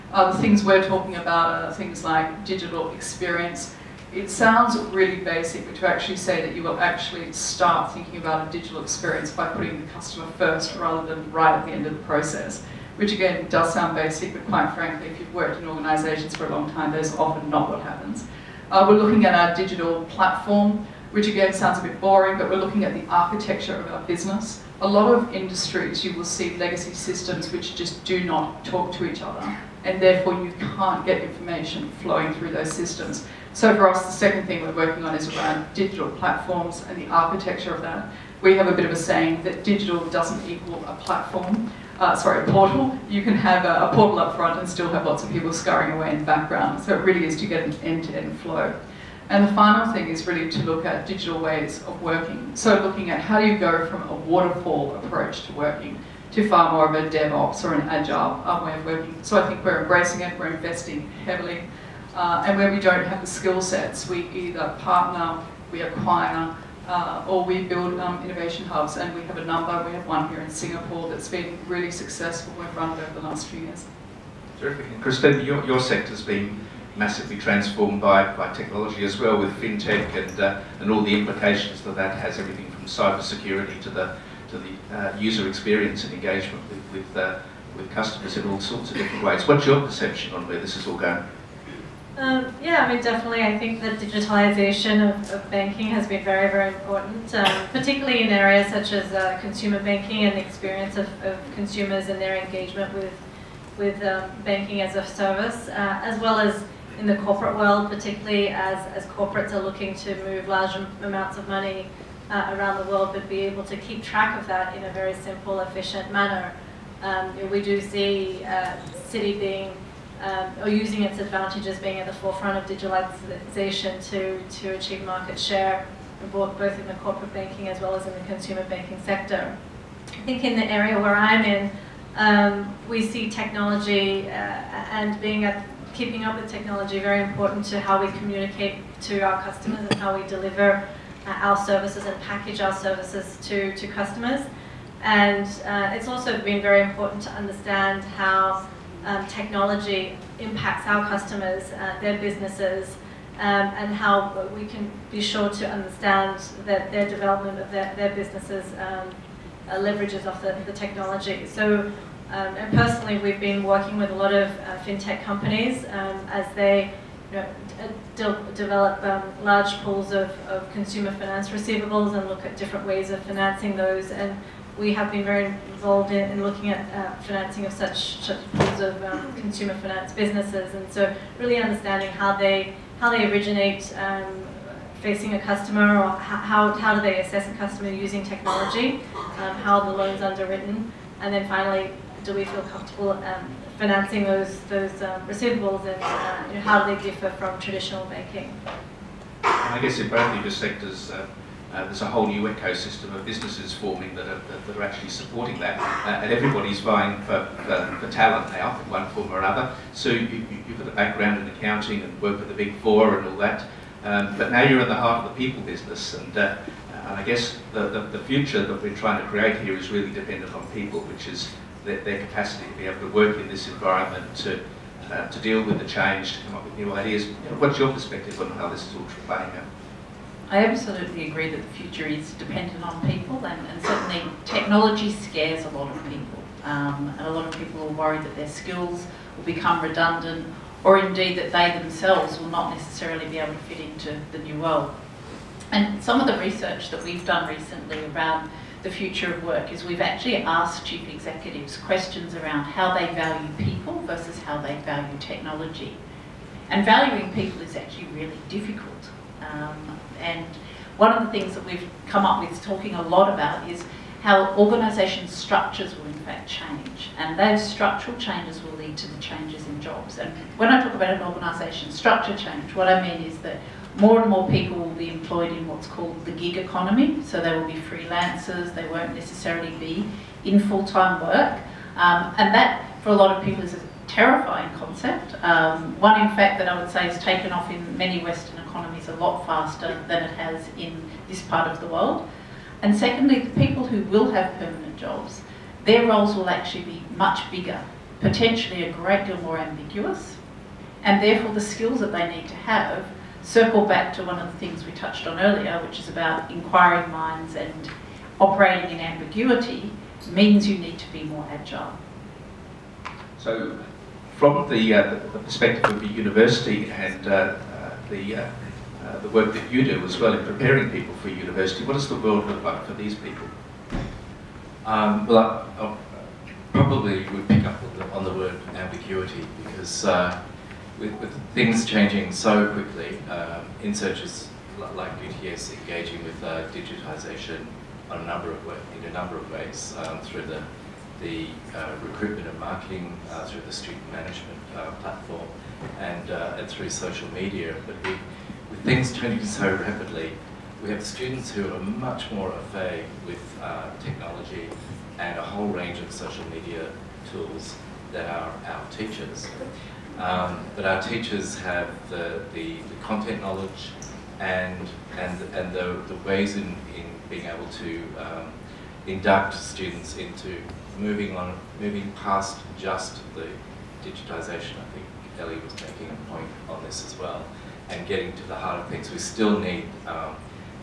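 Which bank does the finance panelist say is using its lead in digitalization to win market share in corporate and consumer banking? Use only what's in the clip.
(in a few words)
Citi.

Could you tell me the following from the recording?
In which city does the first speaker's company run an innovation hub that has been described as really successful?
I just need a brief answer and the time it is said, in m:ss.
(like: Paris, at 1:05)
Singapore, at 1:10.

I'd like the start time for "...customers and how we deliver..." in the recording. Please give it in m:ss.
2:19.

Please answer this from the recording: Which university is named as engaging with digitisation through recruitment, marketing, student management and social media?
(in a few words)
UTS.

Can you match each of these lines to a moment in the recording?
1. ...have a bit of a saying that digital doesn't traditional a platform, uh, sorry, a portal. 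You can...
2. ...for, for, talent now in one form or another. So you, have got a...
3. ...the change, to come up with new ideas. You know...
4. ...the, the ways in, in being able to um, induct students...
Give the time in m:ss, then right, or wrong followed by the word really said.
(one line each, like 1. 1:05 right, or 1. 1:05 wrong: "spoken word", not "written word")
1. 0:38 wrong: "equal", not "traditional"
2. 3:27 right
3. 3:45 right
4. 6:05 right.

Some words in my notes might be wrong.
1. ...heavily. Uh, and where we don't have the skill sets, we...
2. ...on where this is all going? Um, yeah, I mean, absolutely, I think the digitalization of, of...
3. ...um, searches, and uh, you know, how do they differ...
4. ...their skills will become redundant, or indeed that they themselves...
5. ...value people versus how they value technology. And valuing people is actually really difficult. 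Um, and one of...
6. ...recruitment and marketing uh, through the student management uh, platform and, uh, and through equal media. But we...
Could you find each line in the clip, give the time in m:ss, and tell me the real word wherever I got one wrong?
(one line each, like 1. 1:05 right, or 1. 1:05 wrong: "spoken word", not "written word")
1. 1:01 right
2. 1:30 wrong: "definitely", not "absolutely"
3. 3:15 wrong: "receivables", not "searches"
4. 3:58 right
5. 4:13 right
6. 5:42 wrong: "social", not "equal".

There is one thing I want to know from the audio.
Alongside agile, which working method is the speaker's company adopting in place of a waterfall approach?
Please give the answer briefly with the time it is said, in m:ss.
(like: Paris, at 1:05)
DevOps, at 0:57.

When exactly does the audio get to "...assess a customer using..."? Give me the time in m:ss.
3:07.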